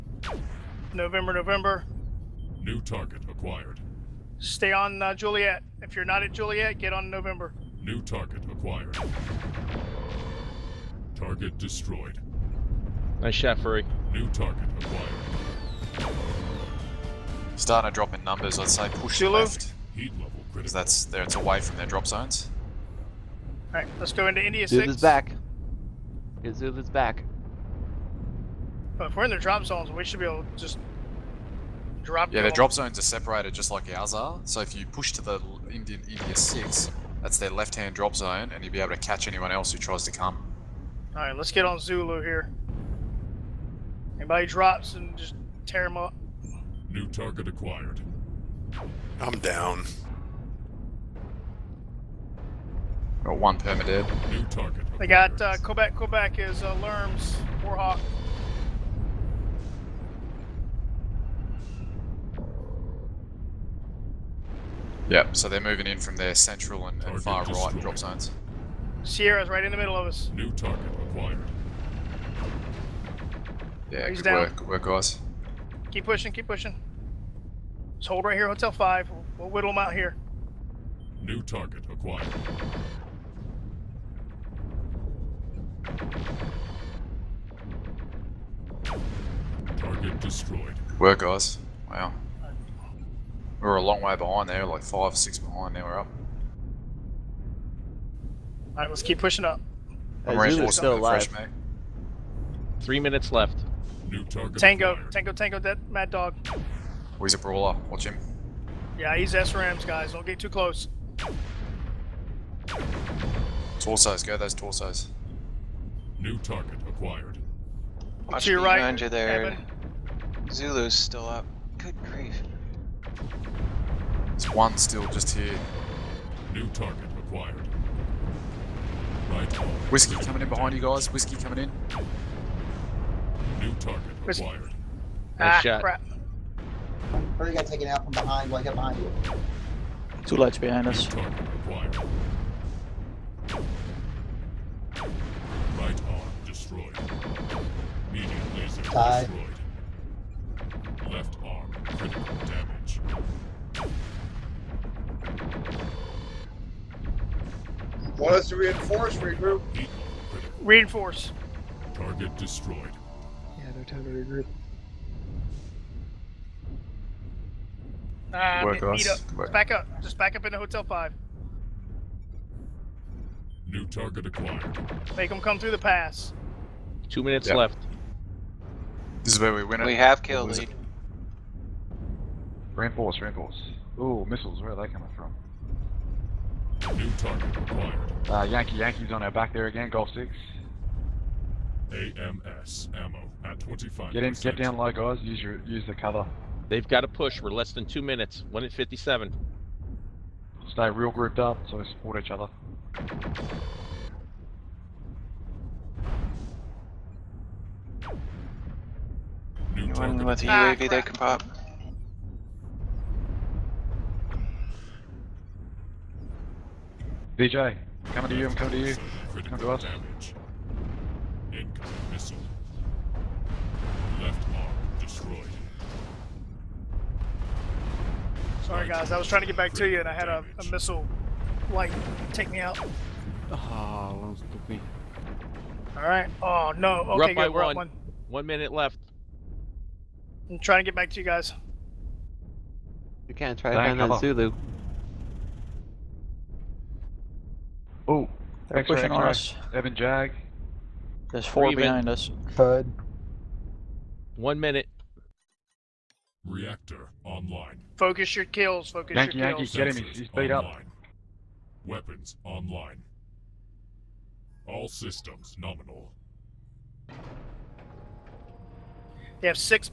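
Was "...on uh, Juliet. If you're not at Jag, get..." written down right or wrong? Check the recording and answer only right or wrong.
wrong.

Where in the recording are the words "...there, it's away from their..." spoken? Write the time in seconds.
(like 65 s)
21 s.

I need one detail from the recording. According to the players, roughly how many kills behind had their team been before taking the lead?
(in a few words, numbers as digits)
6.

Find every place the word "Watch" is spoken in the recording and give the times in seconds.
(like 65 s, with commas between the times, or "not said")
107 s, 118 s.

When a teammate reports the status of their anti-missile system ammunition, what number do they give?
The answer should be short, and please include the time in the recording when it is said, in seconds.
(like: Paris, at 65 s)
25, at 193 s.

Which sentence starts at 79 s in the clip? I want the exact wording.
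We'll, we'll whittle them out here.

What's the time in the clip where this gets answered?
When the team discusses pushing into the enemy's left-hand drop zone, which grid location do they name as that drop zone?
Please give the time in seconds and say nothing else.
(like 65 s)
36 s.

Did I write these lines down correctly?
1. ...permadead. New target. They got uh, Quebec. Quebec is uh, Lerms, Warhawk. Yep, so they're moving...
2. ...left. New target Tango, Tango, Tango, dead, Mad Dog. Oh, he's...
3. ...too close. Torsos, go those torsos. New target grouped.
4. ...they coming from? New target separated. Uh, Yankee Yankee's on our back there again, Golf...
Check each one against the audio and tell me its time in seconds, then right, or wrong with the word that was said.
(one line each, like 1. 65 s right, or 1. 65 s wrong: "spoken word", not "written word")
1. 53 s right
2. 103 s right
3. 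110 s wrong: "acquired", not "grouped"
4. 184 s wrong: "acquired", not "separated".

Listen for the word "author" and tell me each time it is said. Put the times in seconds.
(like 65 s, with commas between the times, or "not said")
not said.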